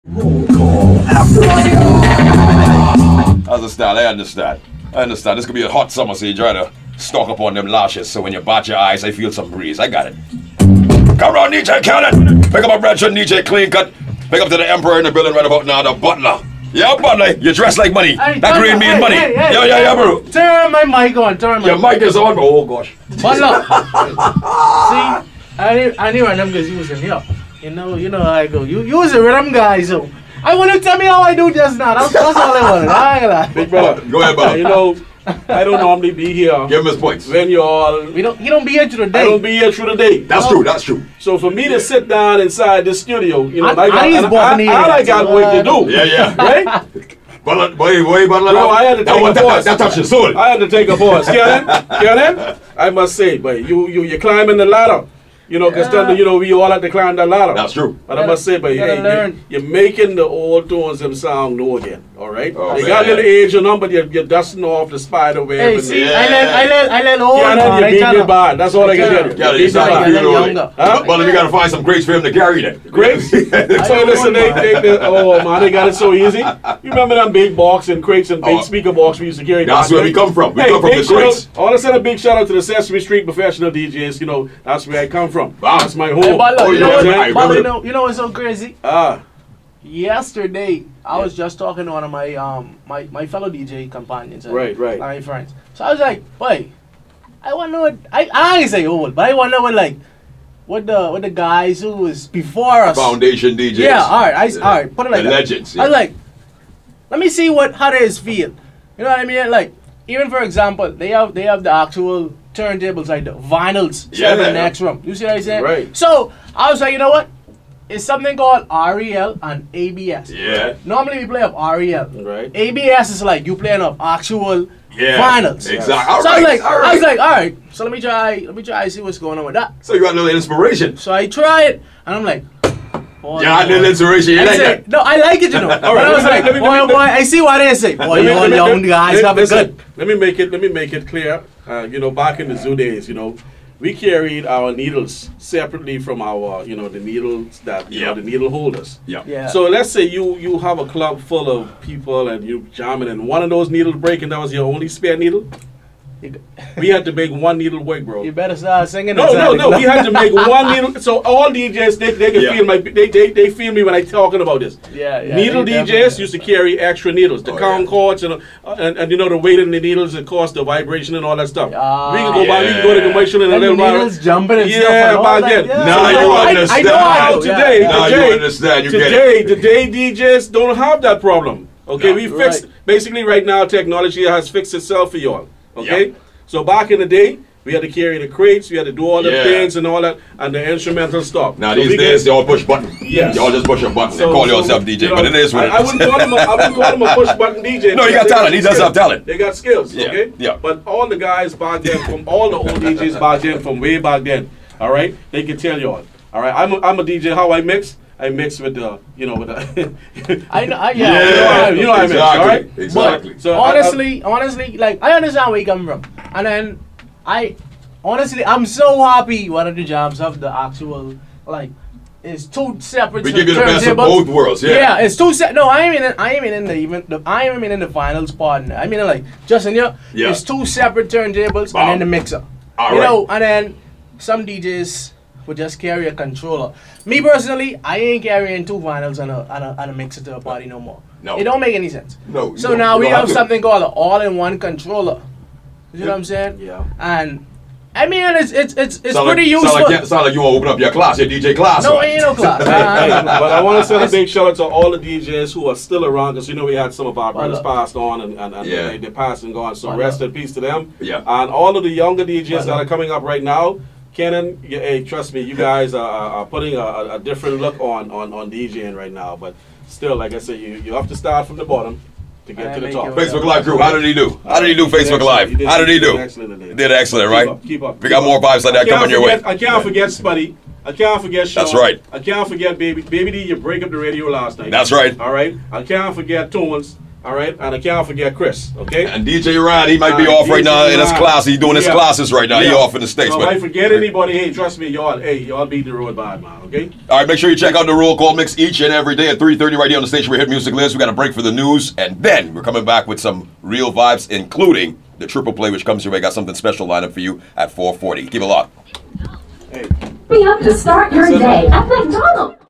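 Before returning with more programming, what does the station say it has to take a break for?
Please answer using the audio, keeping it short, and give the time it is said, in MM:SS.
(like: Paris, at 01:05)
the news, at 05:01.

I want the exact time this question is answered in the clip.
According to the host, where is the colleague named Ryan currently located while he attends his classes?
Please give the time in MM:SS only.
04:52.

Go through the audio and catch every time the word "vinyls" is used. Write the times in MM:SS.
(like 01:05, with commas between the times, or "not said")
01:53, 03:58.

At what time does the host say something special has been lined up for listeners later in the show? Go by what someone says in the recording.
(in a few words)
4:40.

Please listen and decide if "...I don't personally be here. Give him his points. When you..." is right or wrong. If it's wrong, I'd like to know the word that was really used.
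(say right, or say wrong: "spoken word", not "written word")
wrong: "normally", not "personally".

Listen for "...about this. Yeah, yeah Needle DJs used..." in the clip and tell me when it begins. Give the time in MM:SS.
02:44.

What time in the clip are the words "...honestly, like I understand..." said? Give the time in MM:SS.
03:34.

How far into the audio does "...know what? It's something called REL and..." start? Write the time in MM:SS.
01:56.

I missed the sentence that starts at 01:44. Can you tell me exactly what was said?
alright, put it like the that.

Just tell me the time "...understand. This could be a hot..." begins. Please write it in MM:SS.
00:05.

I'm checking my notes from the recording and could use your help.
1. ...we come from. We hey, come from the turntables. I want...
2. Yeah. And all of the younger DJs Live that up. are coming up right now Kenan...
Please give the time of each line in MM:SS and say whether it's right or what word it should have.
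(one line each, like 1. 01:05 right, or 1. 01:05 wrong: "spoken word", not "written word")
1. 01:20 wrong: "crates", not "turntables"
2. 04:21 wrong: "Why", not "Live".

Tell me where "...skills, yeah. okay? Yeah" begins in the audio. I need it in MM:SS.
03:19.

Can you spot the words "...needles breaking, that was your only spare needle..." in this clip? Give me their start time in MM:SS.
02:33.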